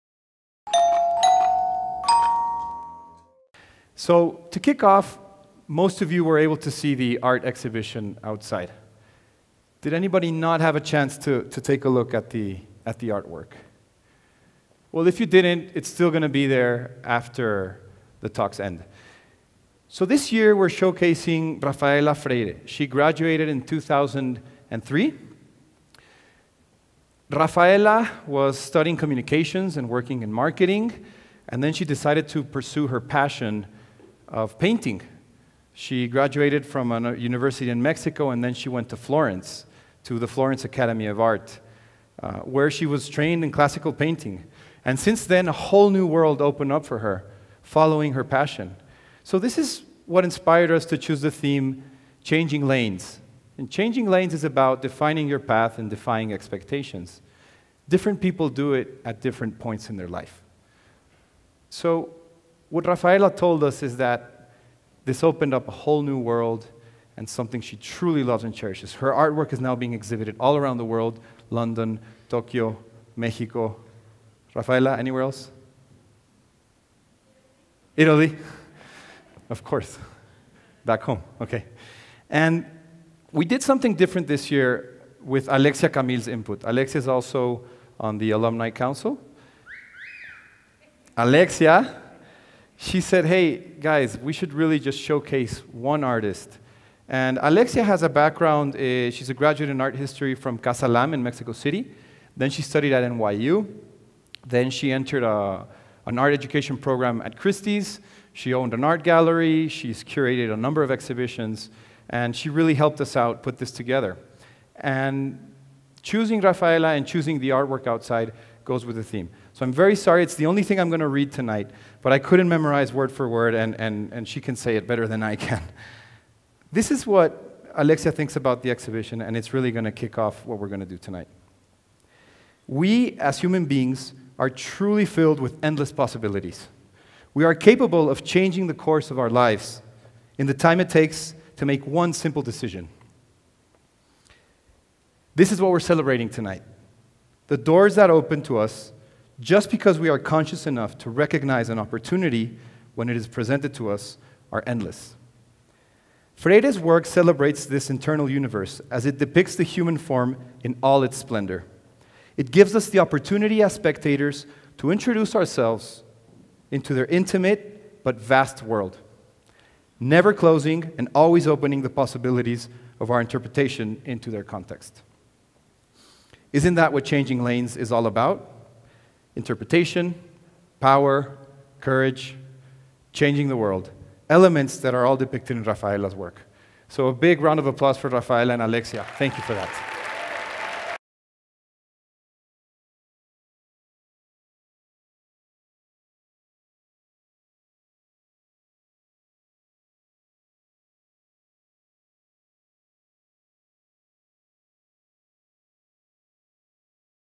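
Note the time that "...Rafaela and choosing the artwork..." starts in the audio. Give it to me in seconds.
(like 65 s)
116 s.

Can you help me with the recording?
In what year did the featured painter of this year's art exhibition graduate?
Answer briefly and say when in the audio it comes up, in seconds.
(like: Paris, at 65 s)
2003, at 23 s.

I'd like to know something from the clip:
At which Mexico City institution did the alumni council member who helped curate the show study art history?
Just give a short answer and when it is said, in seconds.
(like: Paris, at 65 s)
Casa Lamm, at 100 s.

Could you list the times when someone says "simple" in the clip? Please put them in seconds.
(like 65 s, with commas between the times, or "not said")
142 s.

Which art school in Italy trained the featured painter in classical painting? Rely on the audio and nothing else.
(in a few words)
Florence Academy of Art.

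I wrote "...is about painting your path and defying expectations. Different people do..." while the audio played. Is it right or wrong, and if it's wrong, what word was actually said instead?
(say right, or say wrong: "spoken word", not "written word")
wrong: "defining", not "painting".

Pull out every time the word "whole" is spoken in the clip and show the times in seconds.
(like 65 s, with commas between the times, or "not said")
45 s, 65 s.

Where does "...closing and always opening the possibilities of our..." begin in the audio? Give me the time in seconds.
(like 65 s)
170 s.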